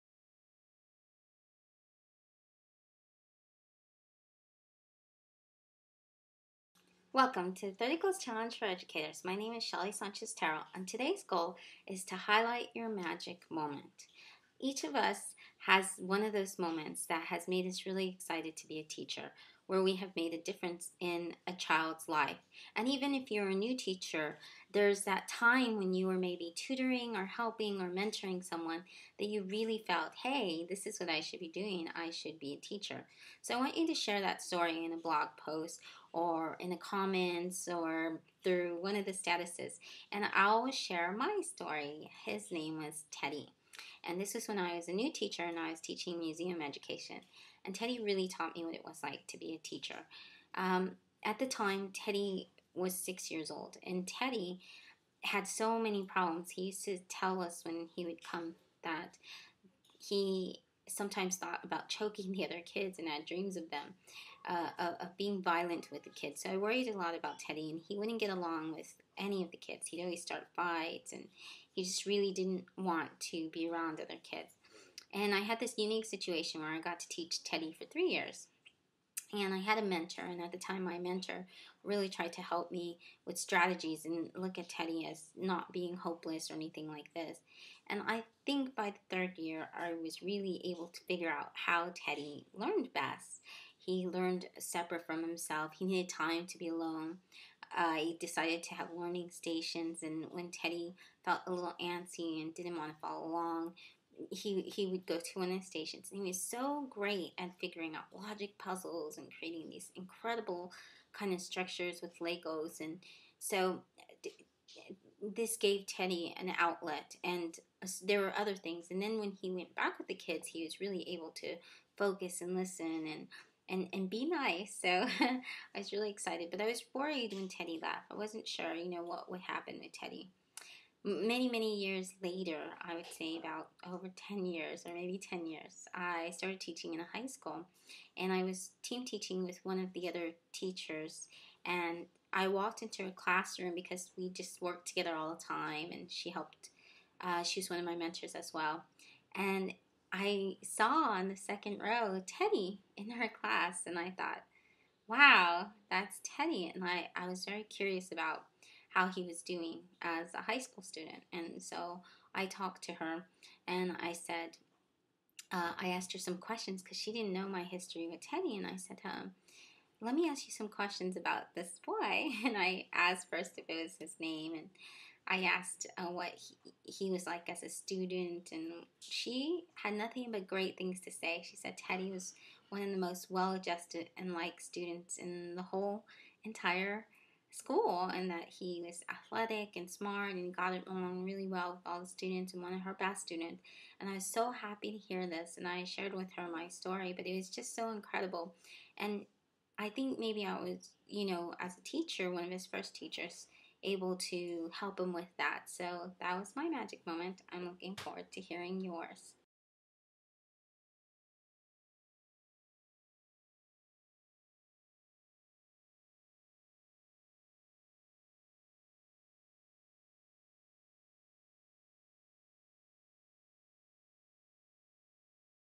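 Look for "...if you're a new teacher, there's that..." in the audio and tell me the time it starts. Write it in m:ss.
0:23.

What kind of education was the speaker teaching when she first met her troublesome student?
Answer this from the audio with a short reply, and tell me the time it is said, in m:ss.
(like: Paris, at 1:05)
museum education, at 0:46.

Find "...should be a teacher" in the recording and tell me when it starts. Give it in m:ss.
0:32.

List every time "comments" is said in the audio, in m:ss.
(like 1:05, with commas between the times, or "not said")
0:36.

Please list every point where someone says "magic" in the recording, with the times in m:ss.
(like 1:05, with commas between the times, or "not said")
0:12, 3:26.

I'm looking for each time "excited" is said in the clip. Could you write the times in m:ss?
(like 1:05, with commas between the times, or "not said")
0:18, 2:06.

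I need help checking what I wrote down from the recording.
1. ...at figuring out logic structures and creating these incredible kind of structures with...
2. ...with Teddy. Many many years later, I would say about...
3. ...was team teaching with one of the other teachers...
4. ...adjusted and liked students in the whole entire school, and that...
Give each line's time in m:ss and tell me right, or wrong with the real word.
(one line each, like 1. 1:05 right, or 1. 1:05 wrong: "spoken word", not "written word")
1. 1:47 wrong: "puzzles", not "structures"
2. 2:09 right
3. 2:18 right
4. 3:03 right.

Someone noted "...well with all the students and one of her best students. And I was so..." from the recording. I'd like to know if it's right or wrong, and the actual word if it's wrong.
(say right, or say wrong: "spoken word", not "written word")
right.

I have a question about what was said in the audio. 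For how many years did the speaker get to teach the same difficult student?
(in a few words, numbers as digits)
3.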